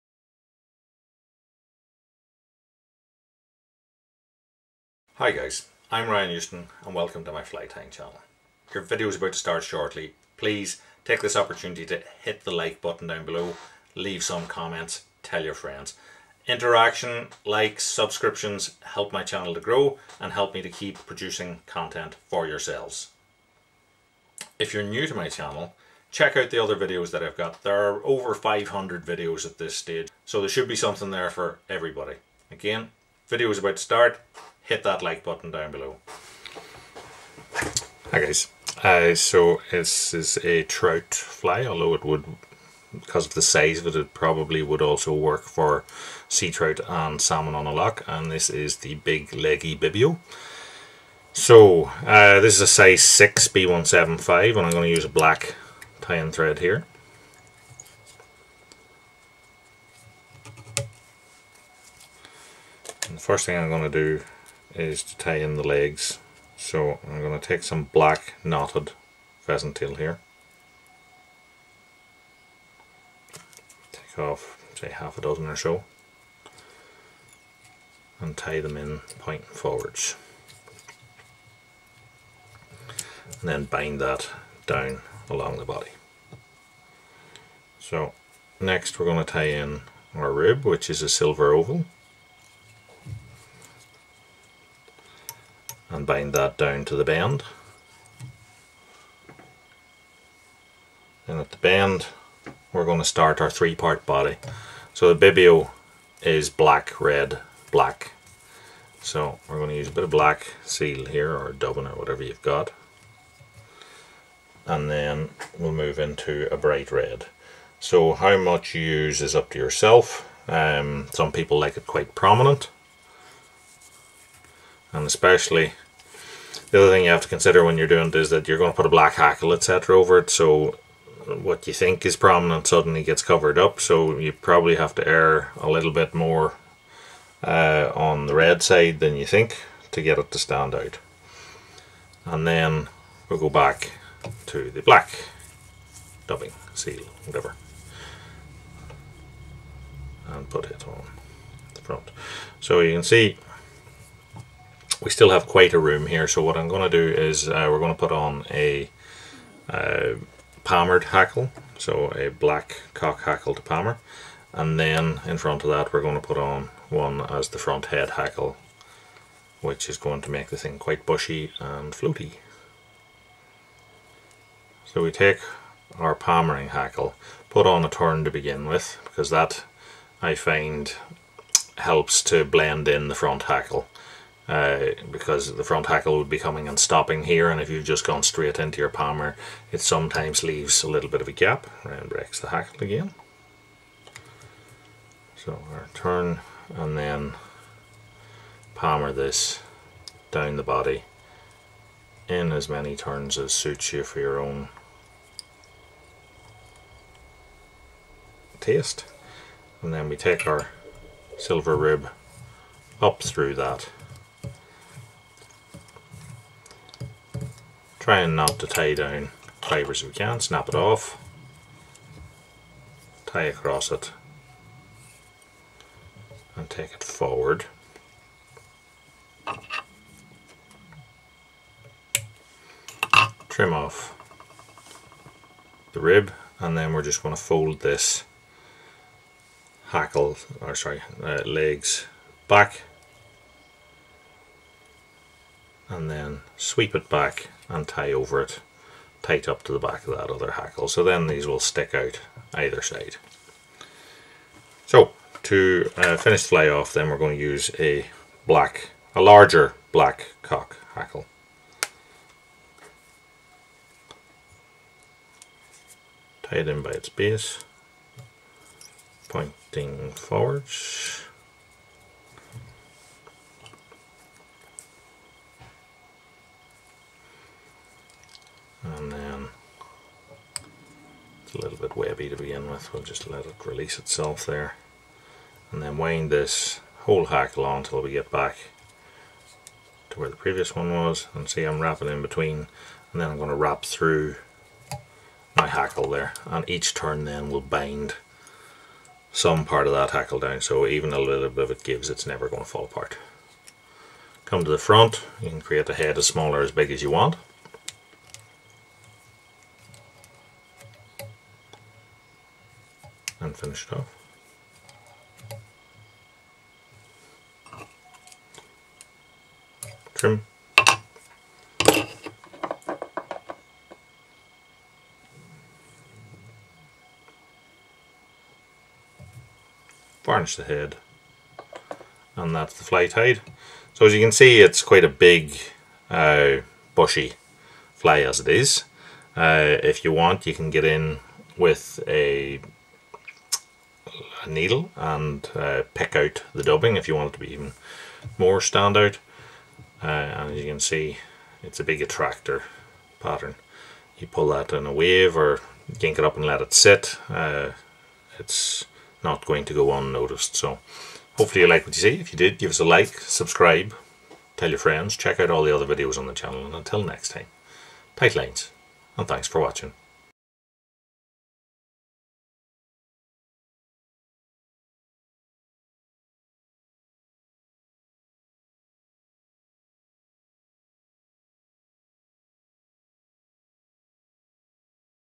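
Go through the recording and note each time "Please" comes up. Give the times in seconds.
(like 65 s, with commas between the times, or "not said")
10 s.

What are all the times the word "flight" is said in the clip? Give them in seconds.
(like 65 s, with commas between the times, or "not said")
332 s.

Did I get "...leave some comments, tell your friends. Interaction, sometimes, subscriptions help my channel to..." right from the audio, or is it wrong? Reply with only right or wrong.
wrong.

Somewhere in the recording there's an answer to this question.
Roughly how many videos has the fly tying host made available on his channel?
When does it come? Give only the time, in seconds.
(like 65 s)
28 s.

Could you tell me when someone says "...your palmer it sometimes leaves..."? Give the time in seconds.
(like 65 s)
188 s.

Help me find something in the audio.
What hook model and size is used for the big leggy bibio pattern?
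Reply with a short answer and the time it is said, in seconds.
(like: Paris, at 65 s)
Size 6 B175, at 52 s.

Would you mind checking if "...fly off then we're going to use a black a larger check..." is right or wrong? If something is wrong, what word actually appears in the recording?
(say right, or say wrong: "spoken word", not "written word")
wrong: "black", not "check".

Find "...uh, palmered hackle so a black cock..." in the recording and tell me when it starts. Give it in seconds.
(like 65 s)
159 s.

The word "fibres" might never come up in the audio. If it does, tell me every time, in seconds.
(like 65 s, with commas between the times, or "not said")
219 s.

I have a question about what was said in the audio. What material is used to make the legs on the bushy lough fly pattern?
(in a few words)
Black knotted pheasant tail.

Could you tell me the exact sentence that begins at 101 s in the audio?
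And at the bend we're going to start our three part body.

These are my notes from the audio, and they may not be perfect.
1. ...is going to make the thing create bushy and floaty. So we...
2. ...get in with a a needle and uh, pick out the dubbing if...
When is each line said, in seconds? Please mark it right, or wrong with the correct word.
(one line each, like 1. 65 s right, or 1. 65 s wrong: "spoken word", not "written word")
1. 169 s wrong: "quite", not "create"
2. 340 s right.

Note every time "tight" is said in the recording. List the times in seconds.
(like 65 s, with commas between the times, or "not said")
249 s, 368 s.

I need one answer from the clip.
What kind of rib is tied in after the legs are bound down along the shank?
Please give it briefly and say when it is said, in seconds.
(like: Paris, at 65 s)
Silver oval, at 91 s.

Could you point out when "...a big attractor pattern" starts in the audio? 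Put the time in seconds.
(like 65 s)
351 s.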